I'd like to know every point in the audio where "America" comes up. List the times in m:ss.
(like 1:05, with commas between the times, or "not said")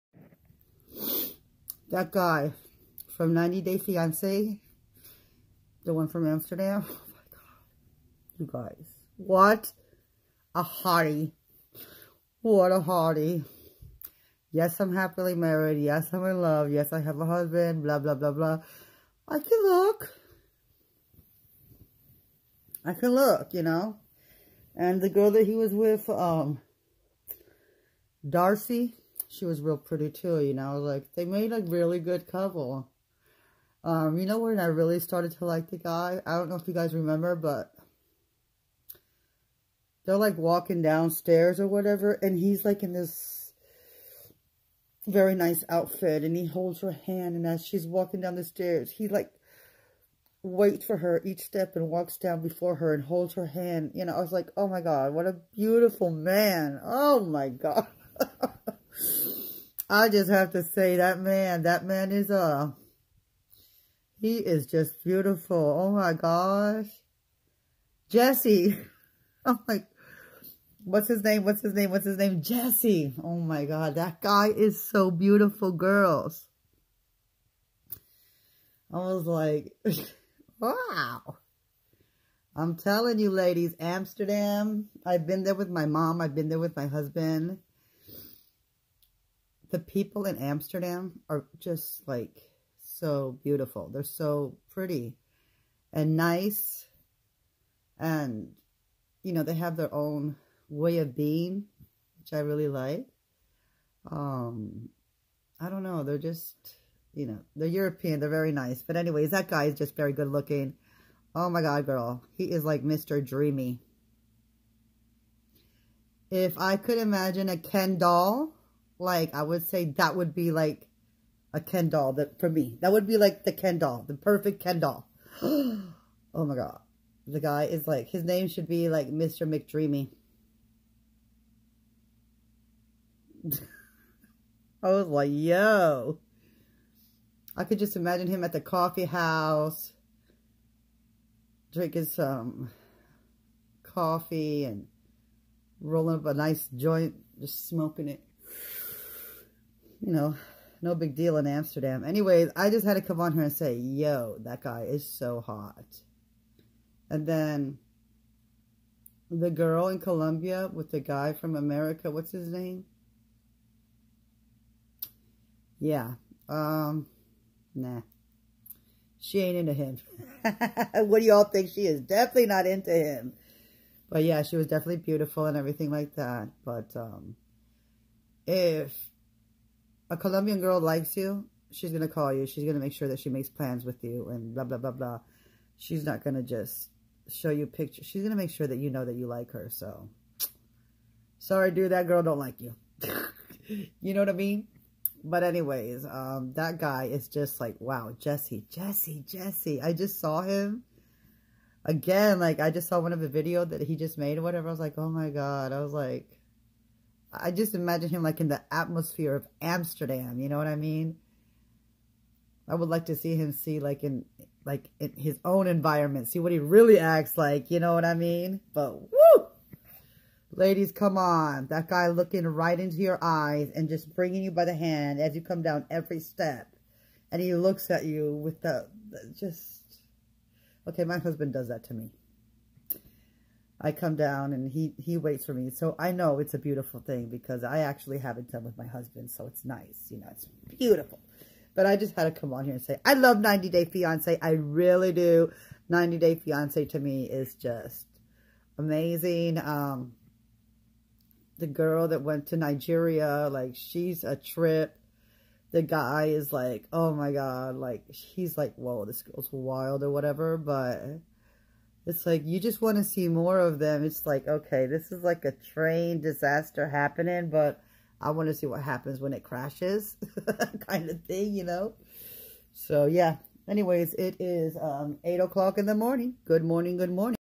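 2:41.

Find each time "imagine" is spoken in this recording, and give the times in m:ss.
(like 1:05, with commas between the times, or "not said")
1:56, 2:17, 3:27.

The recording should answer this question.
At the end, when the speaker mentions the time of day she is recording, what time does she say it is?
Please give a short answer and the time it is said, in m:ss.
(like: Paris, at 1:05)
8 o'clock in the morning, at 4:35.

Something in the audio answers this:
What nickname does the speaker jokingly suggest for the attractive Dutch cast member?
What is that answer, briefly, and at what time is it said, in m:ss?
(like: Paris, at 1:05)
Mr. McDreamy, at 2:09.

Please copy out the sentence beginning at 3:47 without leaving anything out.
And he looks at you with the, the just...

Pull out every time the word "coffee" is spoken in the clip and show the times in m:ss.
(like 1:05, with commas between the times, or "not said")
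2:18, 2:23.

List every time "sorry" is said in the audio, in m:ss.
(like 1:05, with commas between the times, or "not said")
3:11.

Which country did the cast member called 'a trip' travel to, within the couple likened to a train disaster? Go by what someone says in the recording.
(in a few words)
Nigeria.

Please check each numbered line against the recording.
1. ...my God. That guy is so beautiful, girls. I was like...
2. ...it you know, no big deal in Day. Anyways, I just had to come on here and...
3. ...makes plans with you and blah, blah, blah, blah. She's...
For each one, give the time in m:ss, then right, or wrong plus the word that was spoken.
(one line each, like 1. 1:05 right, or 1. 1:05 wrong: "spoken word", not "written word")
1. 1:13 right
2. 2:28 wrong: "Amsterdam", not "Day"
3. 3:03 right.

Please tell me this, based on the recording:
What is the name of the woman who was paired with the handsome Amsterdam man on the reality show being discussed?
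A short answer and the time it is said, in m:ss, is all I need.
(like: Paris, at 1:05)
Darcy, at 0:28.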